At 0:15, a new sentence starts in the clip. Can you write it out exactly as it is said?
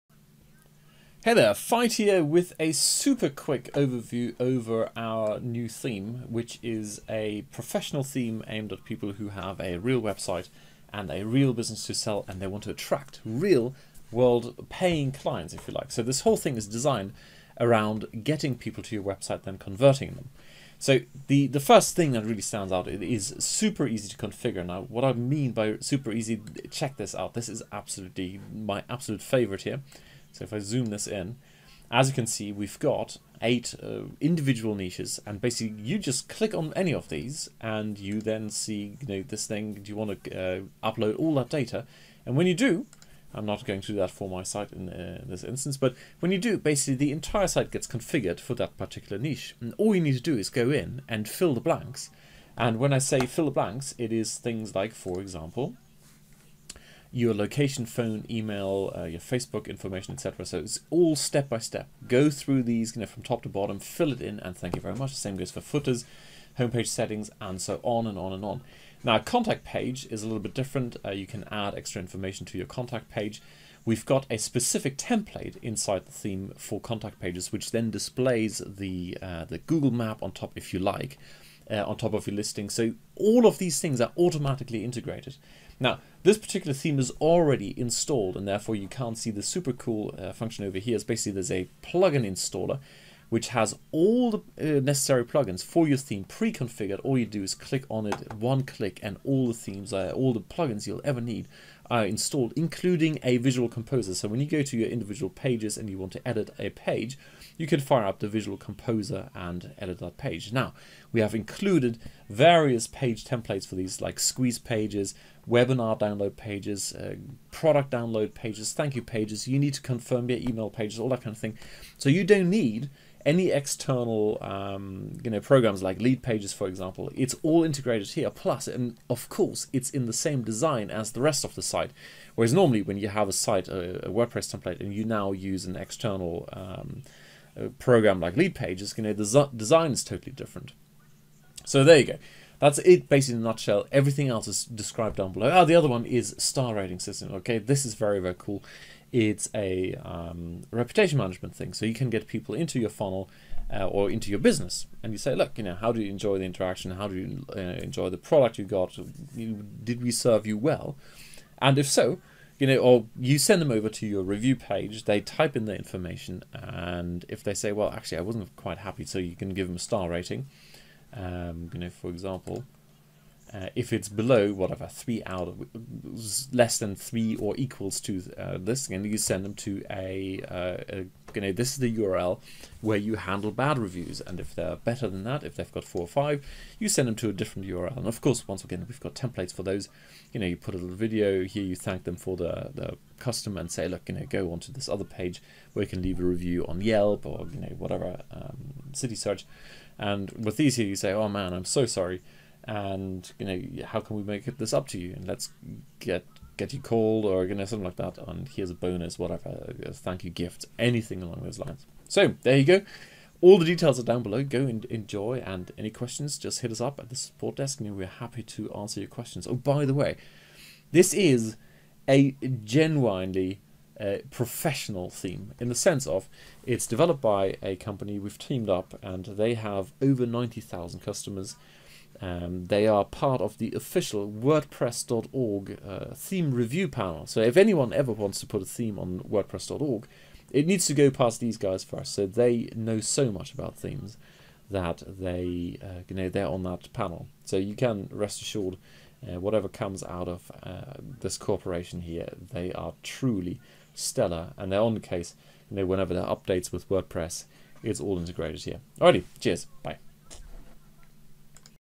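So this whole thing is designed around getting people to your website, then converting them.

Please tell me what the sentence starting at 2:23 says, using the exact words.
Everything else is described down below.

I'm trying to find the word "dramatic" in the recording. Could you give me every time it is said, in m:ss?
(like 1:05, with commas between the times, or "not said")
not said.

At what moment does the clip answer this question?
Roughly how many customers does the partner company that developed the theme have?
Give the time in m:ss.
3:50.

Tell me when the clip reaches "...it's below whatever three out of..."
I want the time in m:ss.
2:53.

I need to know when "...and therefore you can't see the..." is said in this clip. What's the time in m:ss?
1:28.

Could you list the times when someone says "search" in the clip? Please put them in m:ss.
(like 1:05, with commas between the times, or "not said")
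3:19.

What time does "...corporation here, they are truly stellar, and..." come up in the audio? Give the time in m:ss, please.
4:11.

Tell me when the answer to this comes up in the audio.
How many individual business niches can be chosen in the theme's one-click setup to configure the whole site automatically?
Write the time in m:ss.
0:33.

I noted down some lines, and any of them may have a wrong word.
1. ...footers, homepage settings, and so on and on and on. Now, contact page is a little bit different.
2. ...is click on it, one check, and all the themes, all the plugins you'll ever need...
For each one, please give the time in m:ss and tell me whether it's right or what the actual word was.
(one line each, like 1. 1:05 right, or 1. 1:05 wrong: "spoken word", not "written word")
1. 1:05 right
2. 1:37 wrong: "click", not "check".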